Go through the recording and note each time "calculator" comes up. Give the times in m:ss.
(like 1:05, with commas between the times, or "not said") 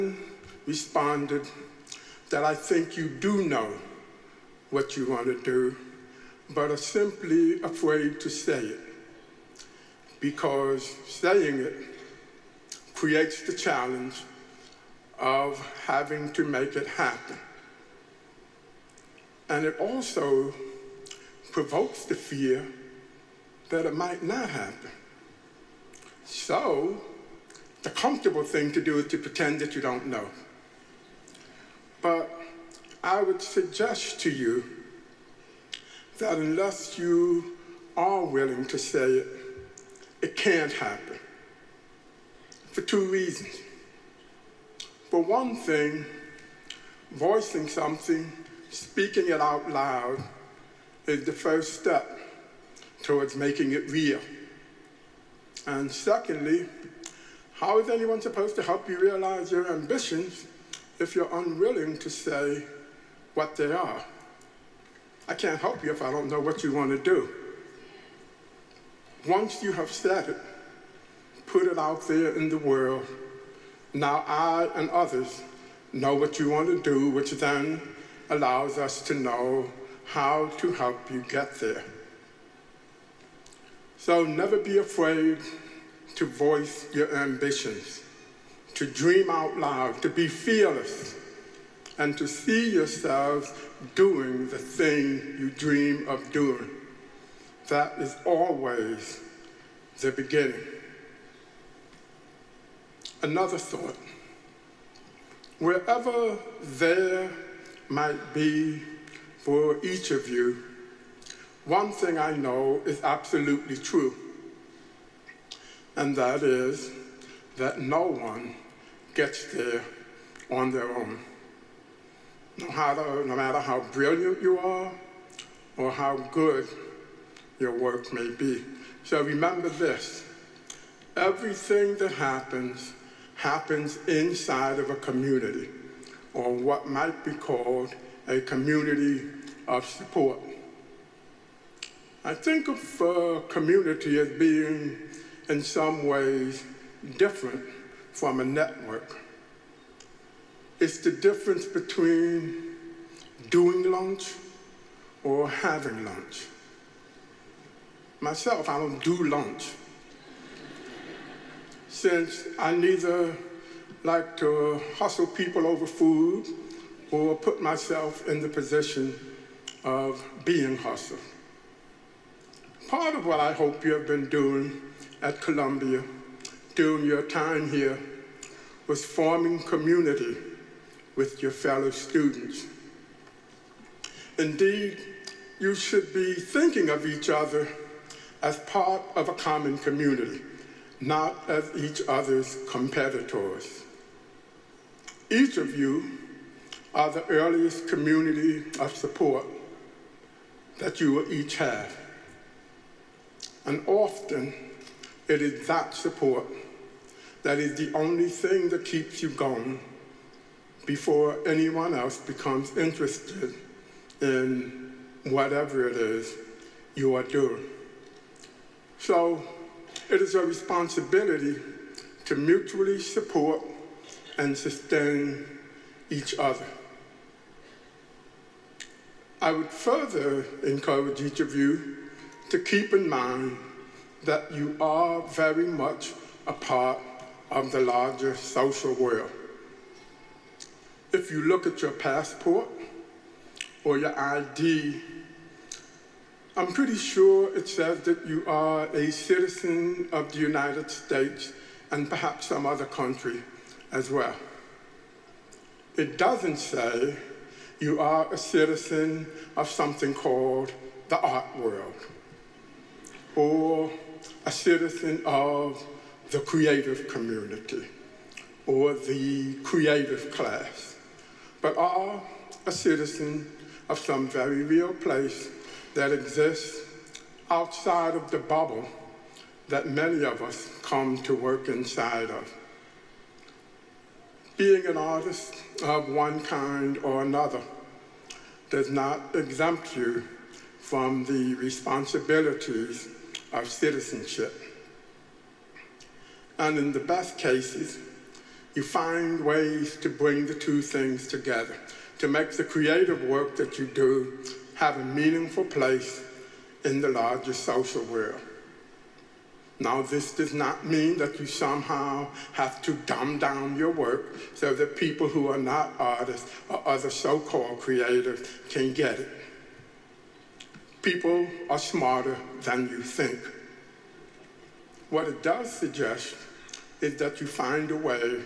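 not said.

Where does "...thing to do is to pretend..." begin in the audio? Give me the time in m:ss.
0:28.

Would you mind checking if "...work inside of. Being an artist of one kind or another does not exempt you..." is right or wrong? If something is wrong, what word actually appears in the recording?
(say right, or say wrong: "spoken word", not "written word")
right.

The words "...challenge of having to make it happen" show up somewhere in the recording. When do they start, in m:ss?
0:13.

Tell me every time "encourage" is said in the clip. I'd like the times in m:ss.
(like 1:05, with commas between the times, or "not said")
3:50.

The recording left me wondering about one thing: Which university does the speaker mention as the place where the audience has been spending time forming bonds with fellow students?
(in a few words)
Columbia.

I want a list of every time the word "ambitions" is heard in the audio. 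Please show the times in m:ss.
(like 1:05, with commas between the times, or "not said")
0:59, 1:27.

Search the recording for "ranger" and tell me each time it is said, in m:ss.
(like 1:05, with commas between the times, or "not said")
not said.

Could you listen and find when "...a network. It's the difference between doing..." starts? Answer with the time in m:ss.
2:28.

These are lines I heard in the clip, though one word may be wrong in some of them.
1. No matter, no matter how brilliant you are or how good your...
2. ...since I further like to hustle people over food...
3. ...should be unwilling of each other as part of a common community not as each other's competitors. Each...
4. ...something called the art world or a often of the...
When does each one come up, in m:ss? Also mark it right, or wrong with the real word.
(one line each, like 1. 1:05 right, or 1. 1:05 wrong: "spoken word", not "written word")
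1. 2:02 right
2. 2:42 wrong: "neither", not "further"
3. 3:05 wrong: "thinking", not "unwilling"
4. 4:19 wrong: "citizen", not "often".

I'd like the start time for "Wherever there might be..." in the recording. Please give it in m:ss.
1:45.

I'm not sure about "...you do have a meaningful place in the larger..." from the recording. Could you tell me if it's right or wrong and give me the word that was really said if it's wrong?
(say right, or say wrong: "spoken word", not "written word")
right.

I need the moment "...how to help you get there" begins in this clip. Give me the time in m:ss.
1:20.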